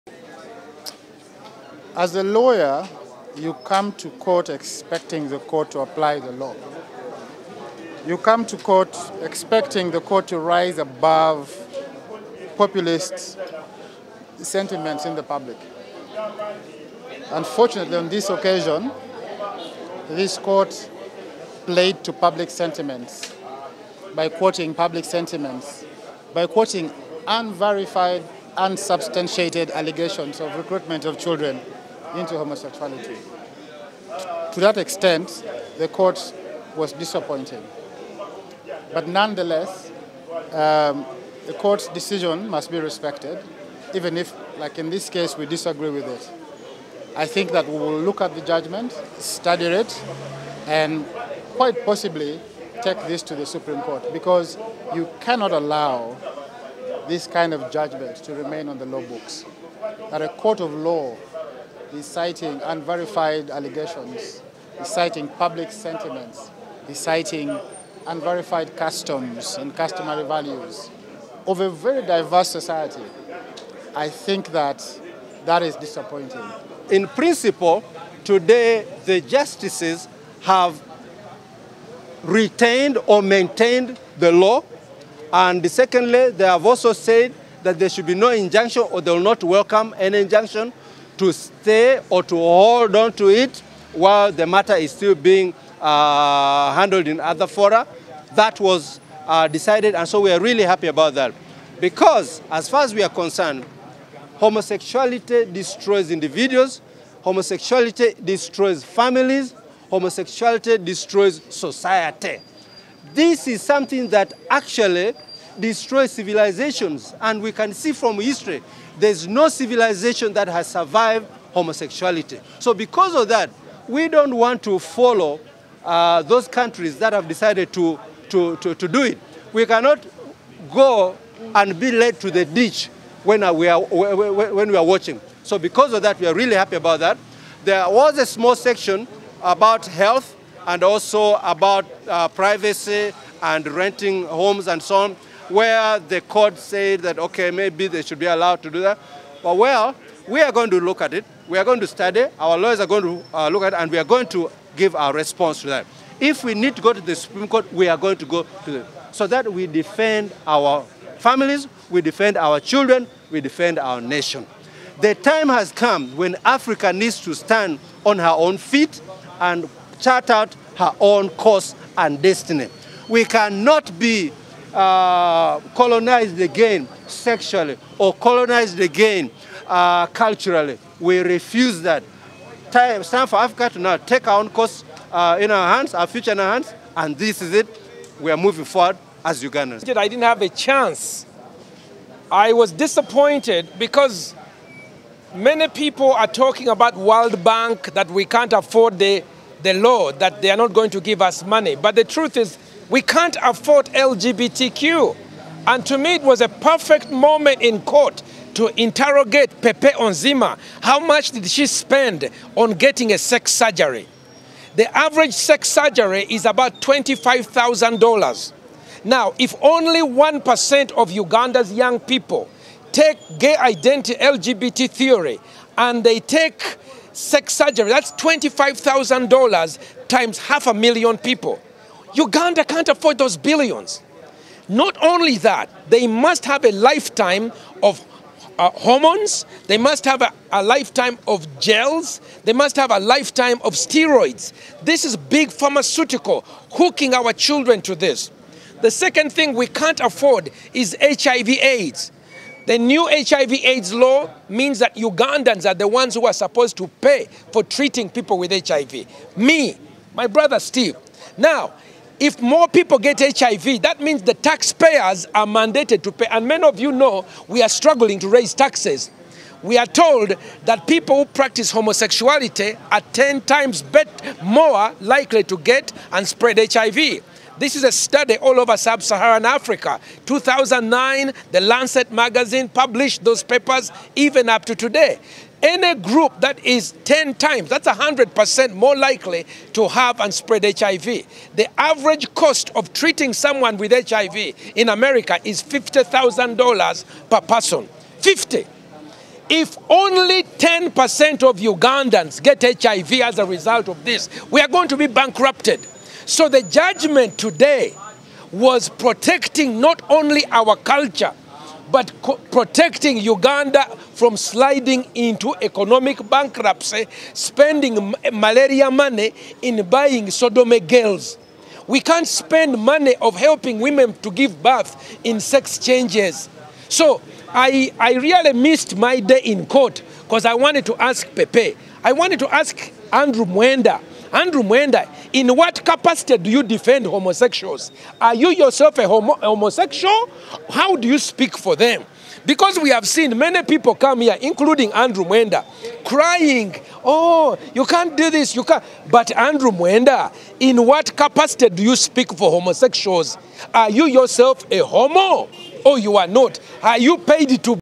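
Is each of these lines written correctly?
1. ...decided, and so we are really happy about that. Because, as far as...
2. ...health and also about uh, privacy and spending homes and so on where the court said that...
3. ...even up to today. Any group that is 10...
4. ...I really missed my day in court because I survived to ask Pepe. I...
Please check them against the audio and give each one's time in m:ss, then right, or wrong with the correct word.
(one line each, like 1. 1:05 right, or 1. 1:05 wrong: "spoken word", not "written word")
1. 1:39 right
2. 2:19 wrong: "renting", not "spending"
3. 4:44 right
4. 5:27 wrong: "wanted", not "survived".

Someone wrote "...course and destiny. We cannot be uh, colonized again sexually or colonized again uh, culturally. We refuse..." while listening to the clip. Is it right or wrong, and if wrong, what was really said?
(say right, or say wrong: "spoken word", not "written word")
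right.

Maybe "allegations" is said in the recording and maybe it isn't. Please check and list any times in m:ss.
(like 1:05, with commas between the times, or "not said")
0:29, 1:03.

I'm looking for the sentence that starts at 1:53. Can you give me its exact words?
This is something that actually destroys civilizations, and we can see from history there's no civilization that has survived homosexuality.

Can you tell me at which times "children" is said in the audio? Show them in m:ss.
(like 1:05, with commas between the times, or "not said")
0:31, 2:42, 4:07.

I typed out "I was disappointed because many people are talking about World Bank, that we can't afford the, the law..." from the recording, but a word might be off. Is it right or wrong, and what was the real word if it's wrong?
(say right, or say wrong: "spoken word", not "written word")
right.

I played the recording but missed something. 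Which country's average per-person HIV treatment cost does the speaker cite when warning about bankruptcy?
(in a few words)
America.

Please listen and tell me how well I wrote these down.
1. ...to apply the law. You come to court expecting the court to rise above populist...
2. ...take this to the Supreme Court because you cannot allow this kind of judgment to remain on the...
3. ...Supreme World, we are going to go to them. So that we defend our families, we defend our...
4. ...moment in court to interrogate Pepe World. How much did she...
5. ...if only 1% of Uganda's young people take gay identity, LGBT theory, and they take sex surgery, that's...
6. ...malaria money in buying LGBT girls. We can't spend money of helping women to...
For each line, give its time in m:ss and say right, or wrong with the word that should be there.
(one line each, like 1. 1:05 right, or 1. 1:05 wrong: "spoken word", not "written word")
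1. 0:05 right
2. 0:52 right
3. 2:37 wrong: "Court", not "World"
4. 3:27 wrong: "Onziema", not "World"
5. 3:39 right
6. 5:18 wrong: "Sodome", not "LGBT".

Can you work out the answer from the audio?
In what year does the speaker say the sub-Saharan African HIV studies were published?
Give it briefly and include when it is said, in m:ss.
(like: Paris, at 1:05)
2009, at 4:40.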